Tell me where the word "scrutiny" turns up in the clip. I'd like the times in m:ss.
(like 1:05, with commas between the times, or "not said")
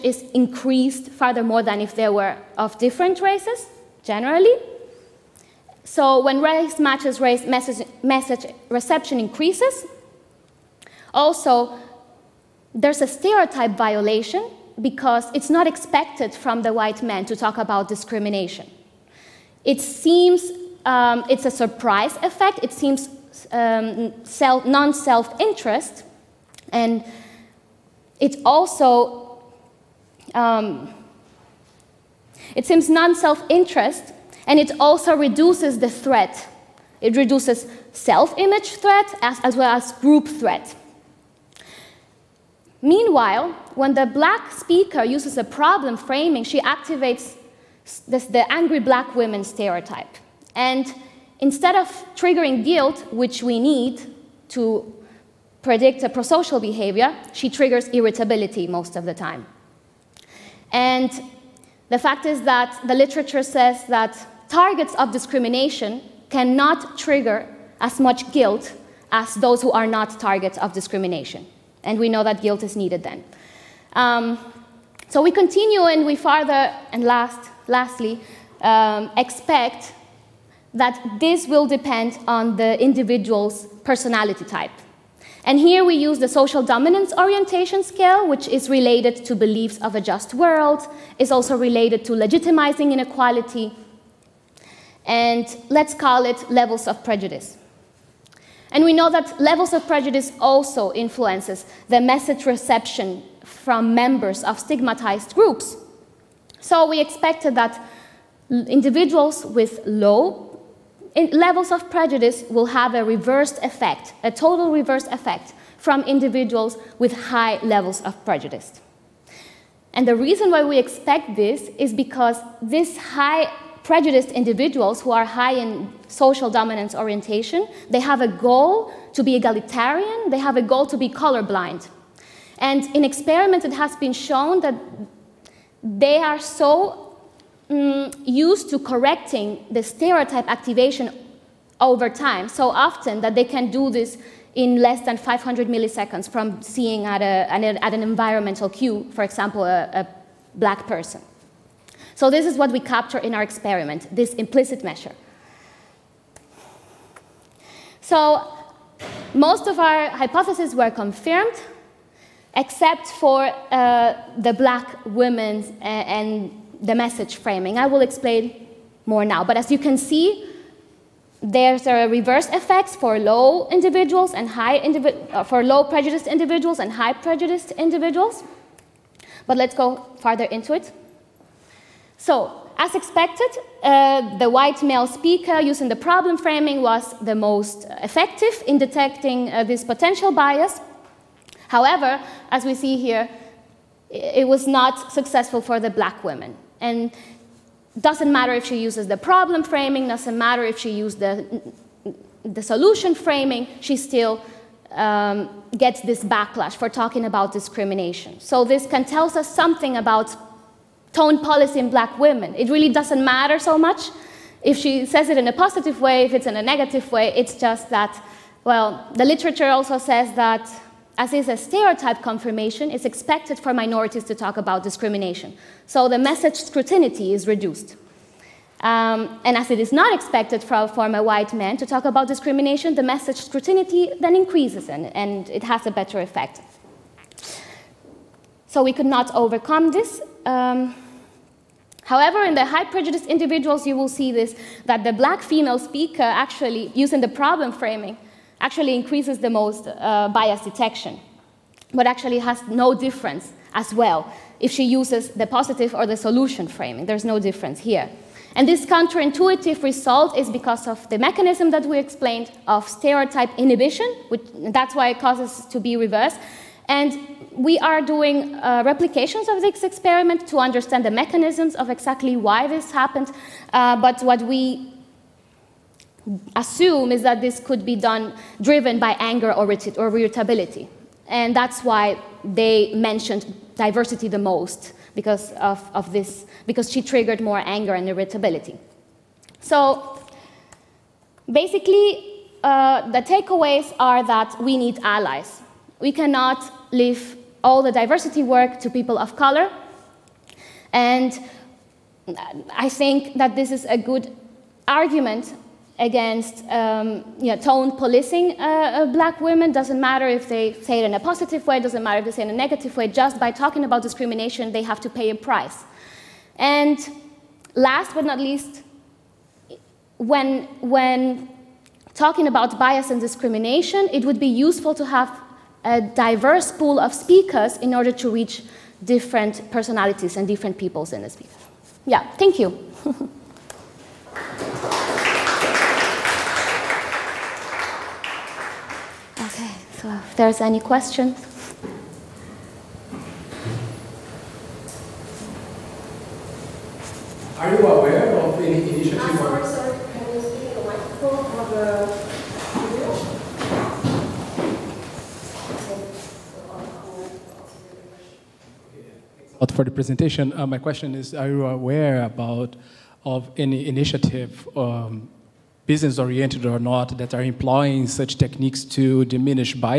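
3:46, 3:53.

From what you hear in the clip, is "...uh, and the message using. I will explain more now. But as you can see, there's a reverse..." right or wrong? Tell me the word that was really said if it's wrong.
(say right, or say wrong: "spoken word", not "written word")
wrong: "framing", not "using".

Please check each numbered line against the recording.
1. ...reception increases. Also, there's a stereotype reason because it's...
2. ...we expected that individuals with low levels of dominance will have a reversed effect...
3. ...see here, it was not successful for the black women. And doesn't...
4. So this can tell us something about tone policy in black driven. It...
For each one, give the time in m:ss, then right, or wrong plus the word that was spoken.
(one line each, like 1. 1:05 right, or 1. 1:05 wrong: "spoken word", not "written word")
1. 0:08 wrong: "violation", not "reason"
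2. 1:46 wrong: "prejudice", not "dominance"
3. 3:12 right
4. 3:28 wrong: "women", not "driven".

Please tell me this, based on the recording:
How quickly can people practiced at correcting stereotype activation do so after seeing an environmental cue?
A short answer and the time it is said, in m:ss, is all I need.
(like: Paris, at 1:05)
Less than 500 milliseconds, at 2:25.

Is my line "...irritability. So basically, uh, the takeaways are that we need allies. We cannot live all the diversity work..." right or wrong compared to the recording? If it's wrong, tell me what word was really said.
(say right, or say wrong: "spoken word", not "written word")
right.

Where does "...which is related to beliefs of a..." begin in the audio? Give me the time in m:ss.
1:28.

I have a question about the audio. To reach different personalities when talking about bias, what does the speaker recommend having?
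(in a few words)
A diverse pool of speakers.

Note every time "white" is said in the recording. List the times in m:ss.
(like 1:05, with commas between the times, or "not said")
0:16, 3:04, 3:51.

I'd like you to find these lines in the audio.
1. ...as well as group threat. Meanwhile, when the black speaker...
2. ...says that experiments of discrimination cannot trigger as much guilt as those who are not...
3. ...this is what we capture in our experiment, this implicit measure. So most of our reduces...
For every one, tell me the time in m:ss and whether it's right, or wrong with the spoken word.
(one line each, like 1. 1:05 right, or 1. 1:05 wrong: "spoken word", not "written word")
1. 0:39 right
2. 1:03 wrong: "targets", not "experiments"
3. 2:32 wrong: "hypotheses", not "reduces".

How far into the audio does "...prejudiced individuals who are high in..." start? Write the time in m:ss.
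2:03.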